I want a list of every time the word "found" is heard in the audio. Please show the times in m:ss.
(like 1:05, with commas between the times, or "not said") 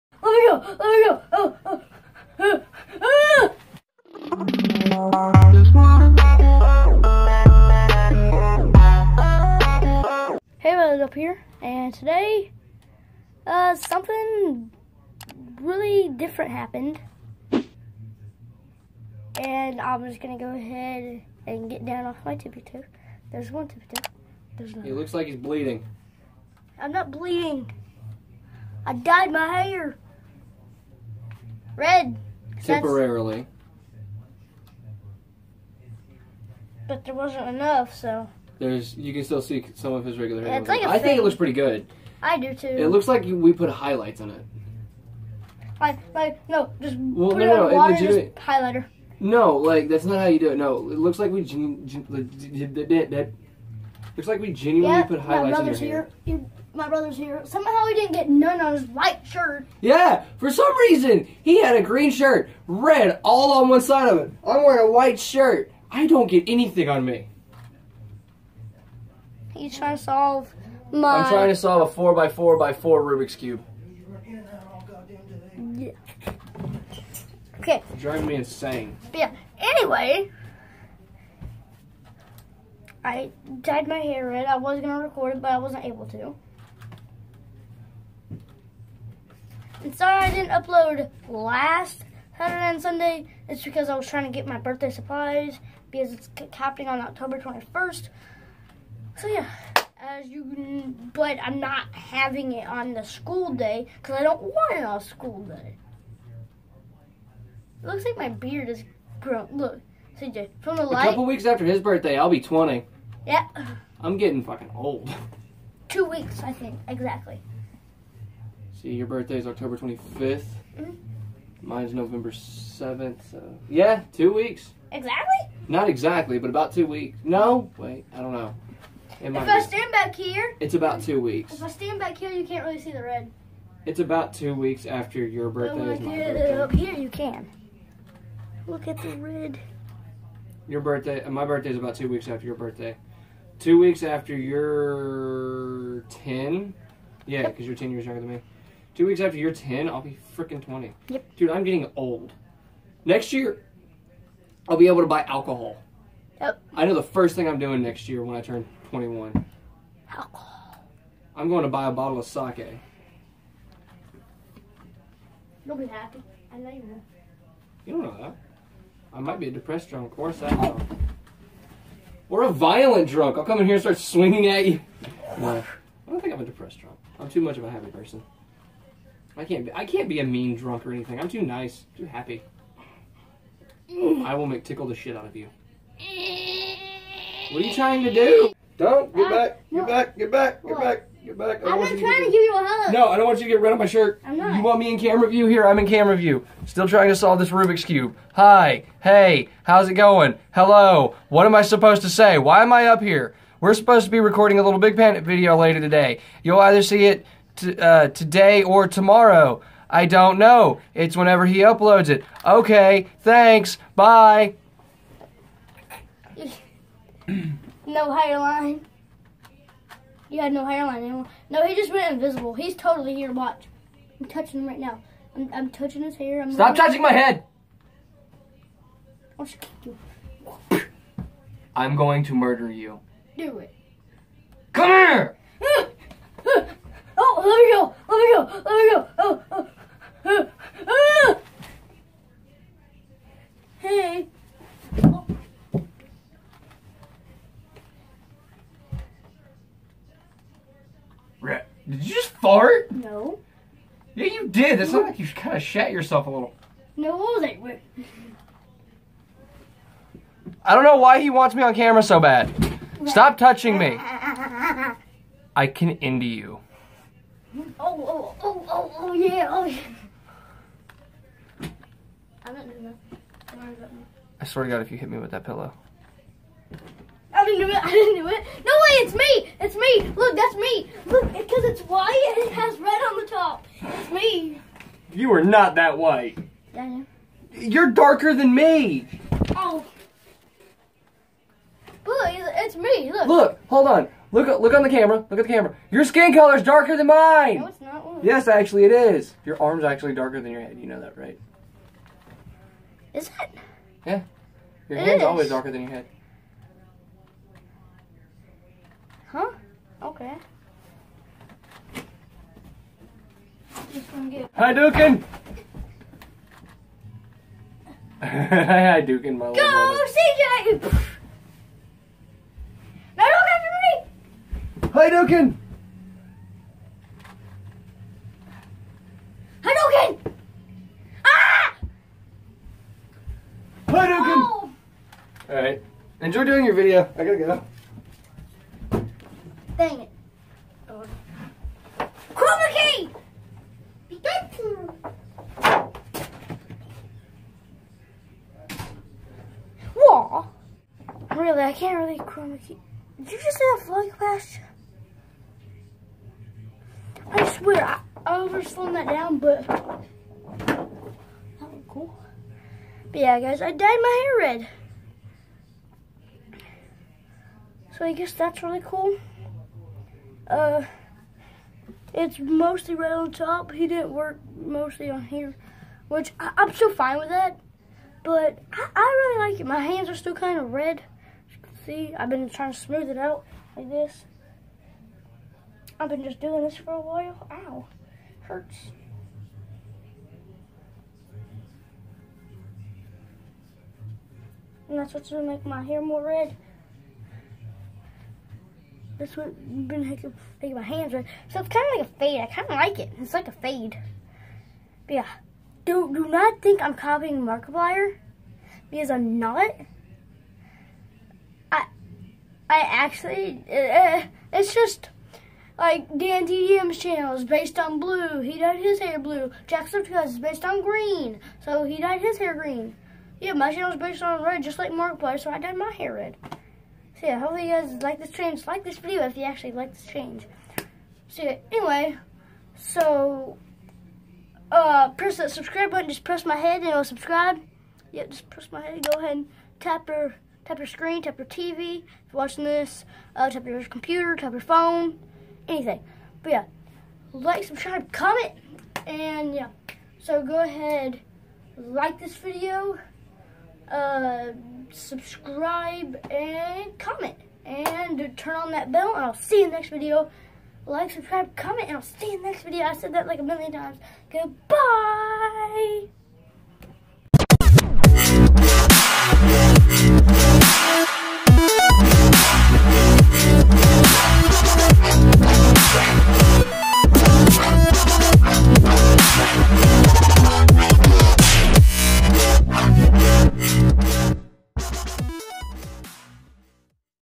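not said.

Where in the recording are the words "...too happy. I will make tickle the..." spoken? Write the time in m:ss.
3:01.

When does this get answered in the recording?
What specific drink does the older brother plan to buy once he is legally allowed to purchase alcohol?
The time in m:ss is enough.
2:42.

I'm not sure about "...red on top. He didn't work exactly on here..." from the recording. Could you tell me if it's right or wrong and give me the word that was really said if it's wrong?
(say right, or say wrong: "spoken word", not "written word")
wrong: "mostly", not "exactly".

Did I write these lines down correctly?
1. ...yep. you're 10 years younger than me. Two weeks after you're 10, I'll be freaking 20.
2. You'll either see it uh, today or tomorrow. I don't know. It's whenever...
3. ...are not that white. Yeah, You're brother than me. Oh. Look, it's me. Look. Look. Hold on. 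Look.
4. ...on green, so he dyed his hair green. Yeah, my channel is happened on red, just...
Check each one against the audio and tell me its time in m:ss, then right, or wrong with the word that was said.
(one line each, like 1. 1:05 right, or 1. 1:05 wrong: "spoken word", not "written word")
1. 2:27 right
2. 3:26 right
3. 4:45 wrong: "darker", not "brother"
4. 7:00 wrong: "based", not "happened".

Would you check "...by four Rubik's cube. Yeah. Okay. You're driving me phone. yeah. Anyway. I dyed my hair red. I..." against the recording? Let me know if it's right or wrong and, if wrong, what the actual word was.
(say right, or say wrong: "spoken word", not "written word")
wrong: "insane", not "phone".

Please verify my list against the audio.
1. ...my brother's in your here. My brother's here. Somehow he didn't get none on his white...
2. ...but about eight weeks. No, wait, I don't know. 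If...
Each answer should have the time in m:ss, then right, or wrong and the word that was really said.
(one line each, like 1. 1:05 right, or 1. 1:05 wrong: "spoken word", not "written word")
1. 0:55 right
2. 2:06 wrong: "two", not "eight".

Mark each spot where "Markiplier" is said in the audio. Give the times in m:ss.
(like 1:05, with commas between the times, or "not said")
6:47, 7:04.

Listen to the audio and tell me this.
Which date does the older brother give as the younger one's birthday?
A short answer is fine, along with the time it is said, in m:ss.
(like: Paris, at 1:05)
October 25th, at 1:59.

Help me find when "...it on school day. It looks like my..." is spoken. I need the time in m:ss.
1:44.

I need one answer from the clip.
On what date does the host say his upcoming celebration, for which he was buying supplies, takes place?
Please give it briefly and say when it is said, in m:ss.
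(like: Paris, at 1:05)
October 21st, at 1:37.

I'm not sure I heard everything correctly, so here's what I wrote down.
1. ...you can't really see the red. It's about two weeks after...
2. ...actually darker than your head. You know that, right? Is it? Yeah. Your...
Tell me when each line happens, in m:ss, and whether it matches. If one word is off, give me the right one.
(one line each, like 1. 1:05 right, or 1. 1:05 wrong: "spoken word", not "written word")
1. 2:12 right
2. 4:59 right.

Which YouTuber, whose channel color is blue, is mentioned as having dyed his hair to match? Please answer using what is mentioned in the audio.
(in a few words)
DanTDM.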